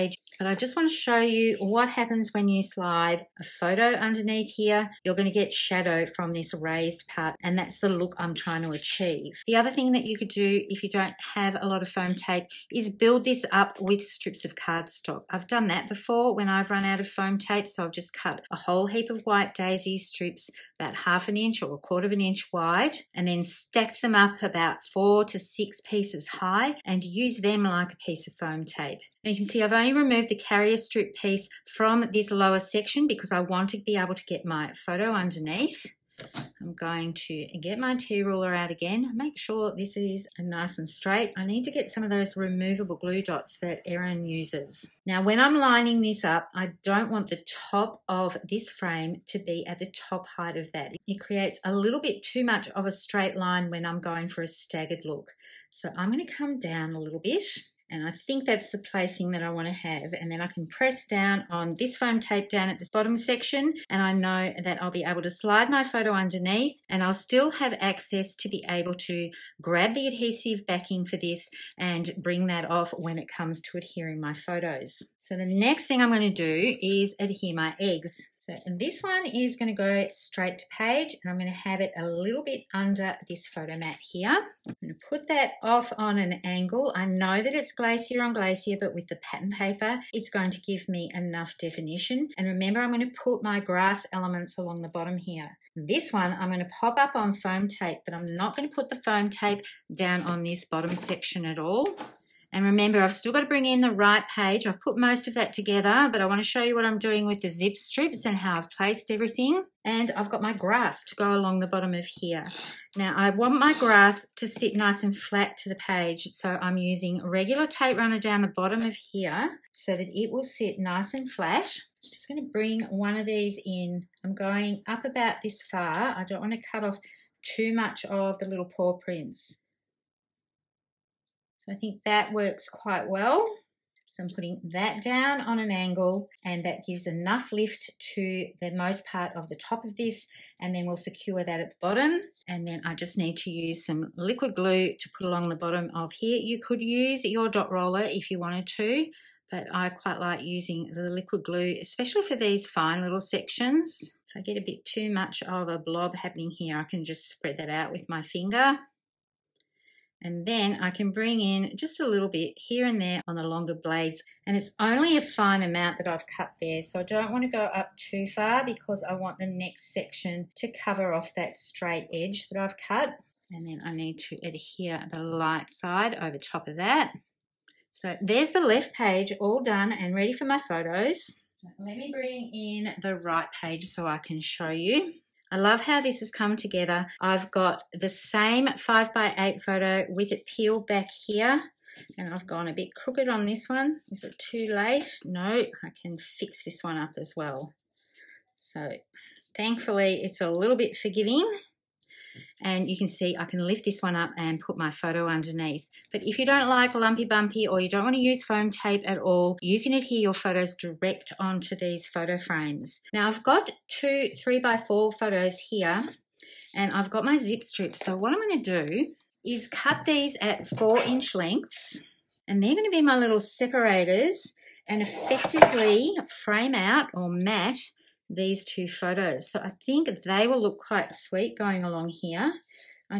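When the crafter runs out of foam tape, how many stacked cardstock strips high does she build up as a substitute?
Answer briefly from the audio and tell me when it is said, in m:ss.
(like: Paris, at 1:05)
4 to 6, at 0:24.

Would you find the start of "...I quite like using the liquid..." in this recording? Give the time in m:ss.
2:29.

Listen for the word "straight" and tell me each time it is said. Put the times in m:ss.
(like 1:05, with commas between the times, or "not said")
0:40, 0:52, 1:20, 2:51.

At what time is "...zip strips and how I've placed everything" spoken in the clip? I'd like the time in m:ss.
1:47.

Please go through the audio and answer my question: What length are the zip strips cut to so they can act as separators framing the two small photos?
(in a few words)
4 inches.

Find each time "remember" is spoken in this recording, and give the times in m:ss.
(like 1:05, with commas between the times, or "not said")
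1:32, 1:42.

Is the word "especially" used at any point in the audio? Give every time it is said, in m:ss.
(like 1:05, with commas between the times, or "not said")
2:31.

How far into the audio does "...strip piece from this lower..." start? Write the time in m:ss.
0:30.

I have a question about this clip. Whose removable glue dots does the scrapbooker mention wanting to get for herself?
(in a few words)
Erin.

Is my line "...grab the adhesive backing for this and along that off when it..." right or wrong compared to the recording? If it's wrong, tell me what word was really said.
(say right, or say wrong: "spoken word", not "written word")
wrong: "bring", not "along".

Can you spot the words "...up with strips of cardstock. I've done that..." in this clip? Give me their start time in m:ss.
0:13.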